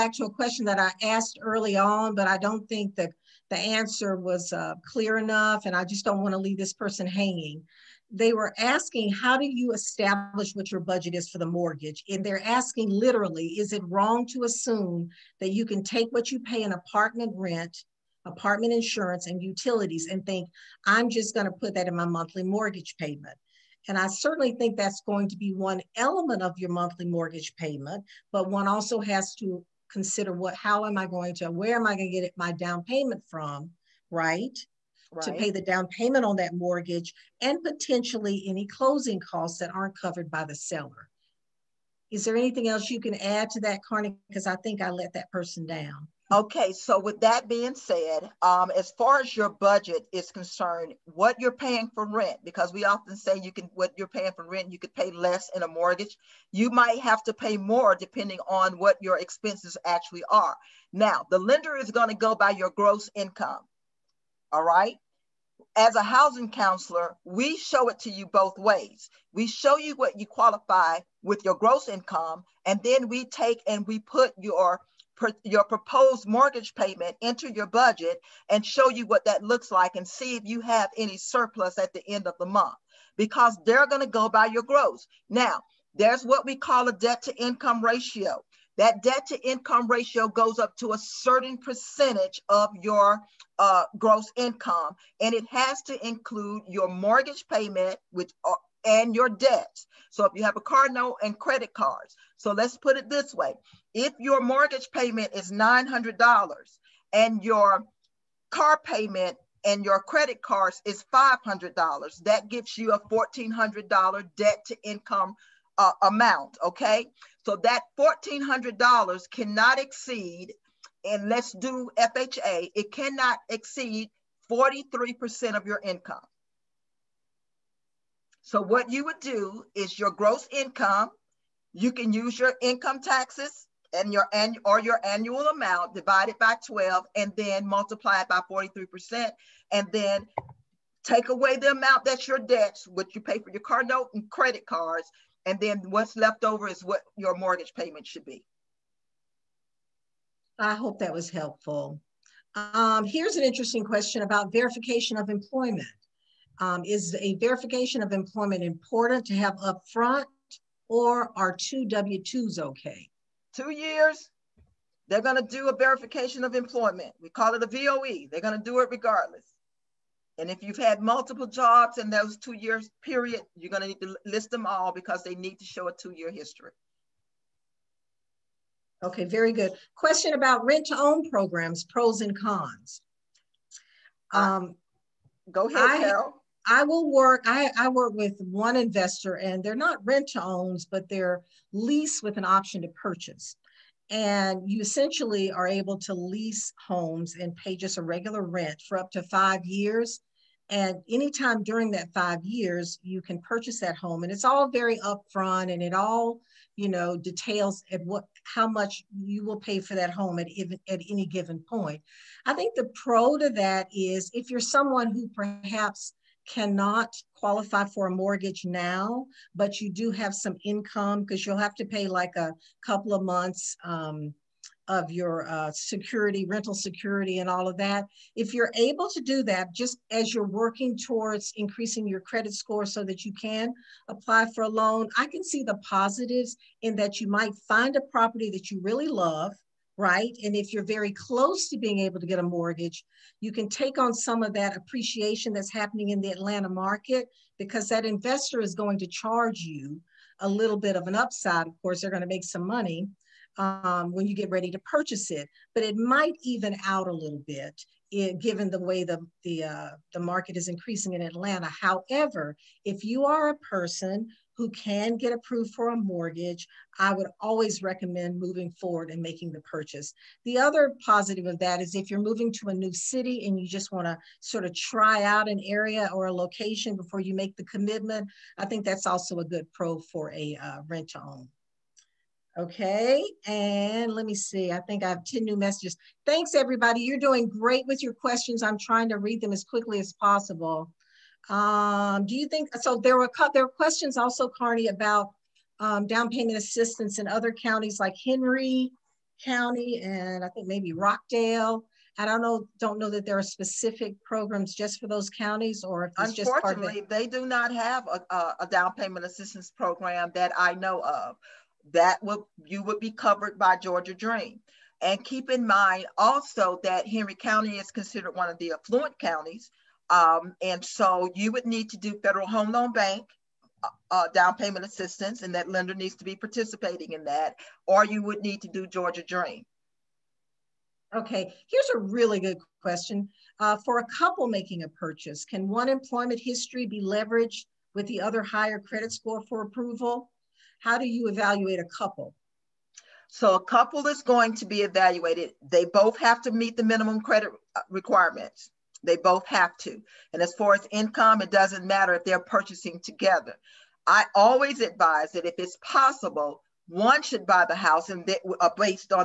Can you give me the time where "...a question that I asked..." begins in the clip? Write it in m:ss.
0:00.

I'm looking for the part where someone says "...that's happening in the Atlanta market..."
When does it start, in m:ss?
4:05.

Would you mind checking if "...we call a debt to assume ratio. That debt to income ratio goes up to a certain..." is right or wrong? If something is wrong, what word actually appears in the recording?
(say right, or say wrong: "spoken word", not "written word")
wrong: "income", not "assume".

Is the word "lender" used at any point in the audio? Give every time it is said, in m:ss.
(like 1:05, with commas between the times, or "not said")
1:01, 5:25.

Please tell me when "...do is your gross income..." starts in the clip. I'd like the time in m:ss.
2:09.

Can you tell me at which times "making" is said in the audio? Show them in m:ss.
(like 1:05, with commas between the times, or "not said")
4:29, 5:34.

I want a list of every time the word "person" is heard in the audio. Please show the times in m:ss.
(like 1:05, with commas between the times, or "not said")
0:06, 0:45, 4:23.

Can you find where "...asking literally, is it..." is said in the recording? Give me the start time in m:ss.
0:12.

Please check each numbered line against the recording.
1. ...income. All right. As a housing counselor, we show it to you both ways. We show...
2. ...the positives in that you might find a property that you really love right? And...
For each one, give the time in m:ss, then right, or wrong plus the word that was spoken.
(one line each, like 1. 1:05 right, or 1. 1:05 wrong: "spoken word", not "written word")
1. 1:03 right
2. 3:55 right.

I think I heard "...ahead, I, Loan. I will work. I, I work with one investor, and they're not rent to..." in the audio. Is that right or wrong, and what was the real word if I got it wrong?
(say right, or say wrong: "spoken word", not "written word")
wrong: "Carol", not "Loan".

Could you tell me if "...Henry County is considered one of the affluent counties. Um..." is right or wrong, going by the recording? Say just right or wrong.
right.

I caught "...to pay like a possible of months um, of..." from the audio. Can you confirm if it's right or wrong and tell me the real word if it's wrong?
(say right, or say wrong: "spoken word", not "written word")
wrong: "couple", not "possible".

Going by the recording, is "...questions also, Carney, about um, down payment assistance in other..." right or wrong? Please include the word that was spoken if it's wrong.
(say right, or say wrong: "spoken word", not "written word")
right.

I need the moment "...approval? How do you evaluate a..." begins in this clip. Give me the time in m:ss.
5:39.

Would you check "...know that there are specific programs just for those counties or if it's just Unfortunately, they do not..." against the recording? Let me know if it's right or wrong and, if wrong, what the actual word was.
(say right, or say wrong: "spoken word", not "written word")
right.